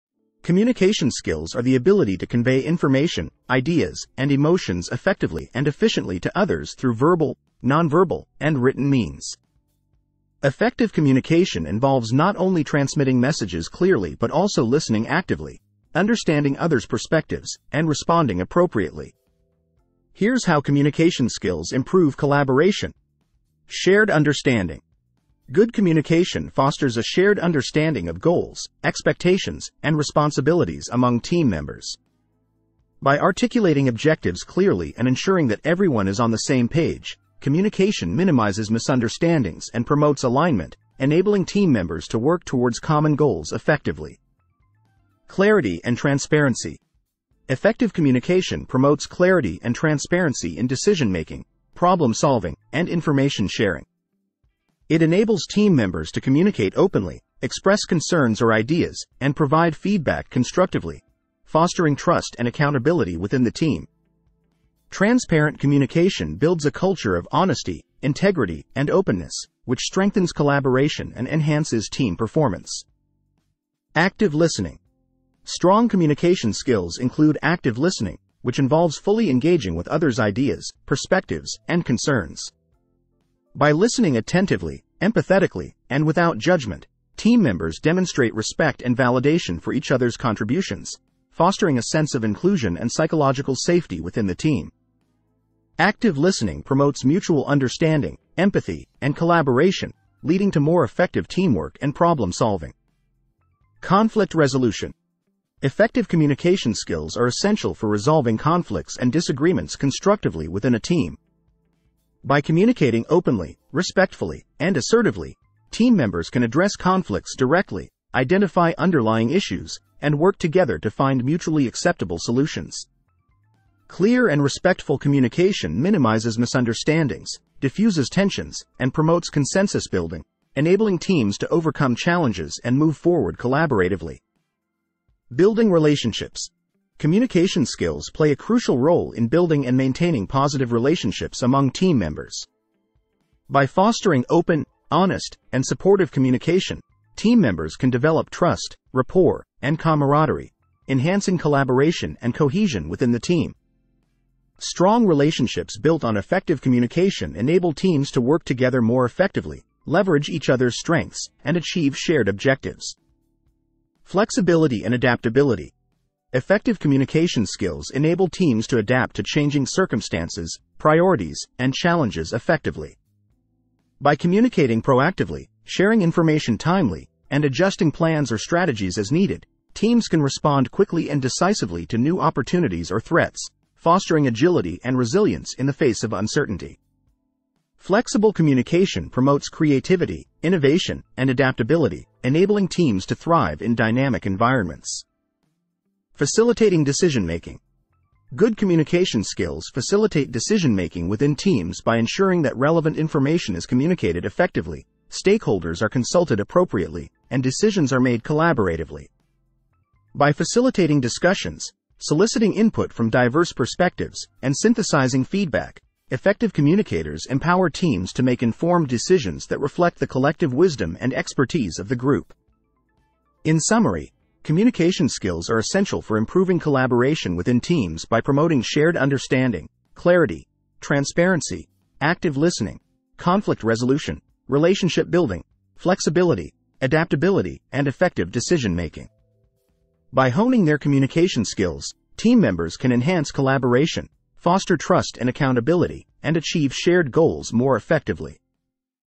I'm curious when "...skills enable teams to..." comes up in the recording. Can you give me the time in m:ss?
2:47.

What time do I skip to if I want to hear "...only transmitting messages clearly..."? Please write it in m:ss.
0:12.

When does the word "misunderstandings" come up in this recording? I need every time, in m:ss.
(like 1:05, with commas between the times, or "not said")
0:38, 2:06.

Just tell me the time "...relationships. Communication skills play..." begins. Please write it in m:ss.
2:15.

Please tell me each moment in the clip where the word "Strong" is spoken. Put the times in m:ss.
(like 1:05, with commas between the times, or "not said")
1:15, 2:34.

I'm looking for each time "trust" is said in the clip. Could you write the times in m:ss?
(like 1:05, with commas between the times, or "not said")
1:01, 2:28, 4:04.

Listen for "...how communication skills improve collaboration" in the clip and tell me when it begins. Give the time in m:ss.
0:20.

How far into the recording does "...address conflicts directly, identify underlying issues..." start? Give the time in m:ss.
1:56.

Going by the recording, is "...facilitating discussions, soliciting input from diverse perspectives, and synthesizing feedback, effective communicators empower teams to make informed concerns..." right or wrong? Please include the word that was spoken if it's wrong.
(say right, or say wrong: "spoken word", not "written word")
wrong: "decisions", not "concerns".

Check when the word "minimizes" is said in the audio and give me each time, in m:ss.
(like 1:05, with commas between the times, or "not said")
0:38, 2:05.